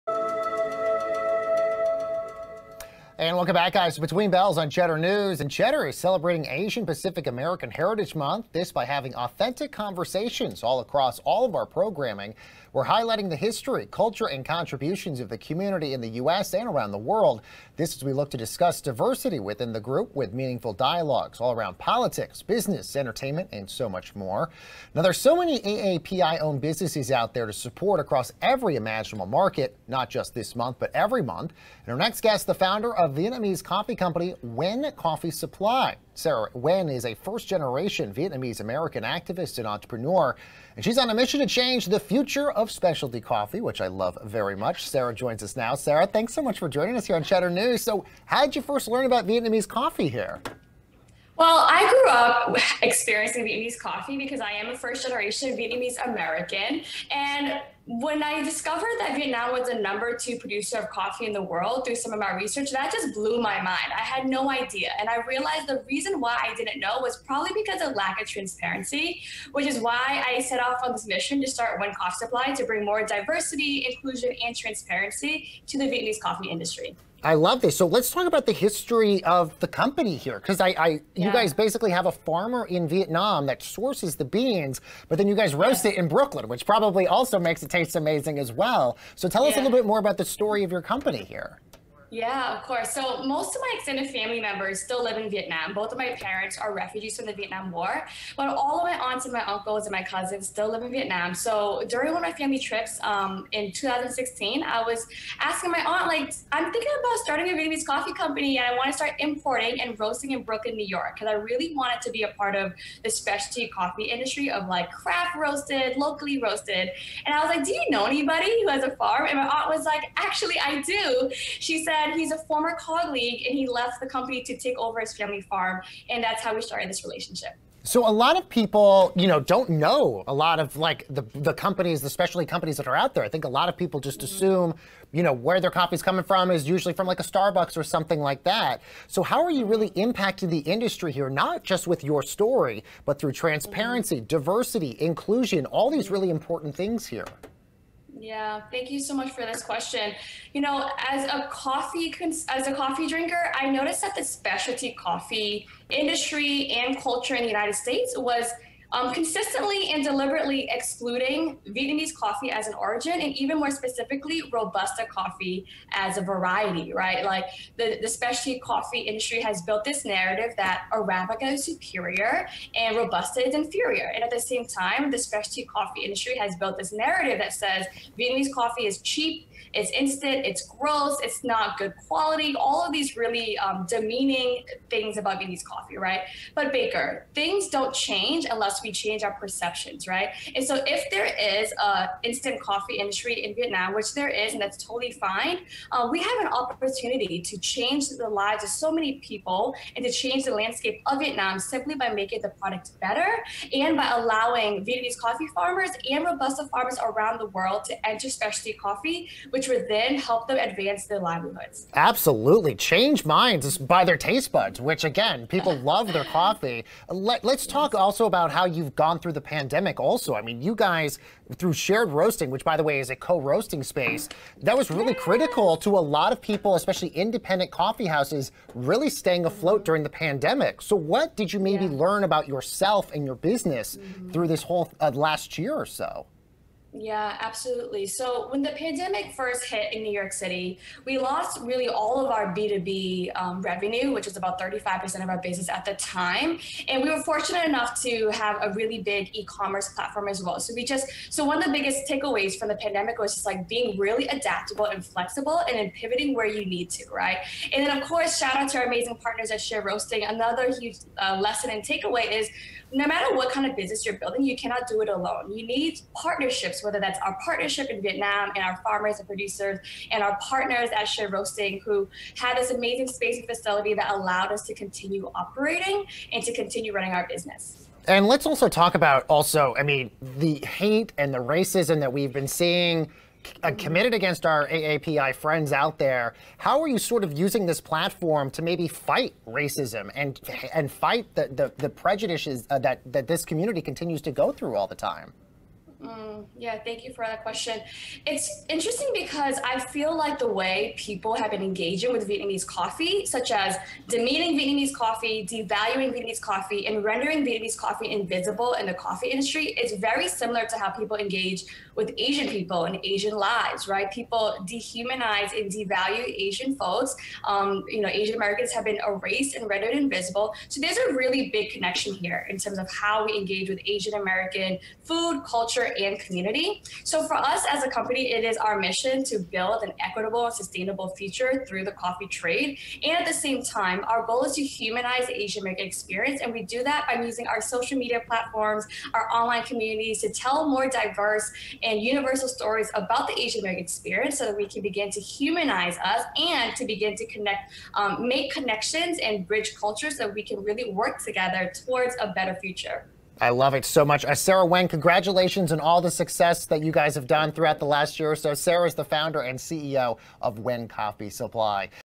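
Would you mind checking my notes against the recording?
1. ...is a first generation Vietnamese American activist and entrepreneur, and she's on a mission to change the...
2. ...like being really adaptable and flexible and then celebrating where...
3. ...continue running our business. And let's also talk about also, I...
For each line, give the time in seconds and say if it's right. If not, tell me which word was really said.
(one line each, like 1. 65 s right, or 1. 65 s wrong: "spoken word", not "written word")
1. 36 s right
2. 253 s wrong: "pivoting", not "celebrating"
3. 276 s right.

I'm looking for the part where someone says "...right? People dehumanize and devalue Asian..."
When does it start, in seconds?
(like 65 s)
313 s.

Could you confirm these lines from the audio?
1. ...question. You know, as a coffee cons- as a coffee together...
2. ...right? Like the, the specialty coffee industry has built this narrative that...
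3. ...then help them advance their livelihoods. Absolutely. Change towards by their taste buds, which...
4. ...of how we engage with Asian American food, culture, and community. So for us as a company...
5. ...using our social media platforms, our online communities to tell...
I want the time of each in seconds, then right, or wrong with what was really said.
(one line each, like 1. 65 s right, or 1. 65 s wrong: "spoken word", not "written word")
1. 149 s wrong: "drinker", not "together"
2. 166 s right
3. 209 s wrong: "minds", not "towards"
4. 322 s right
5. 337 s right.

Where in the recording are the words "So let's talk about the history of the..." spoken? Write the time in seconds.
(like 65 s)
77 s.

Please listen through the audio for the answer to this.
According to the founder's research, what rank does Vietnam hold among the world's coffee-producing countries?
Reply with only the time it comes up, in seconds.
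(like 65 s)
59 s.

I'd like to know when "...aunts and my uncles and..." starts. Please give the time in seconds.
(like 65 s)
98 s.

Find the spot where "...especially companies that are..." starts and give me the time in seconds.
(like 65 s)
132 s.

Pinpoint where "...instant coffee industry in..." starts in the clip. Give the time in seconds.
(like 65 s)
192 s.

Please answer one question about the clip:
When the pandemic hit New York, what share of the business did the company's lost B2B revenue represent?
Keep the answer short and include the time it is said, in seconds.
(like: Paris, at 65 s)
35%, at 244 s.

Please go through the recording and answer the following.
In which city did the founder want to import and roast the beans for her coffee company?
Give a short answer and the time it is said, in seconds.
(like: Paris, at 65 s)
Brooklyn, New York, at 110 s.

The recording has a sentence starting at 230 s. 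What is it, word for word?
So what did you maybe yeah.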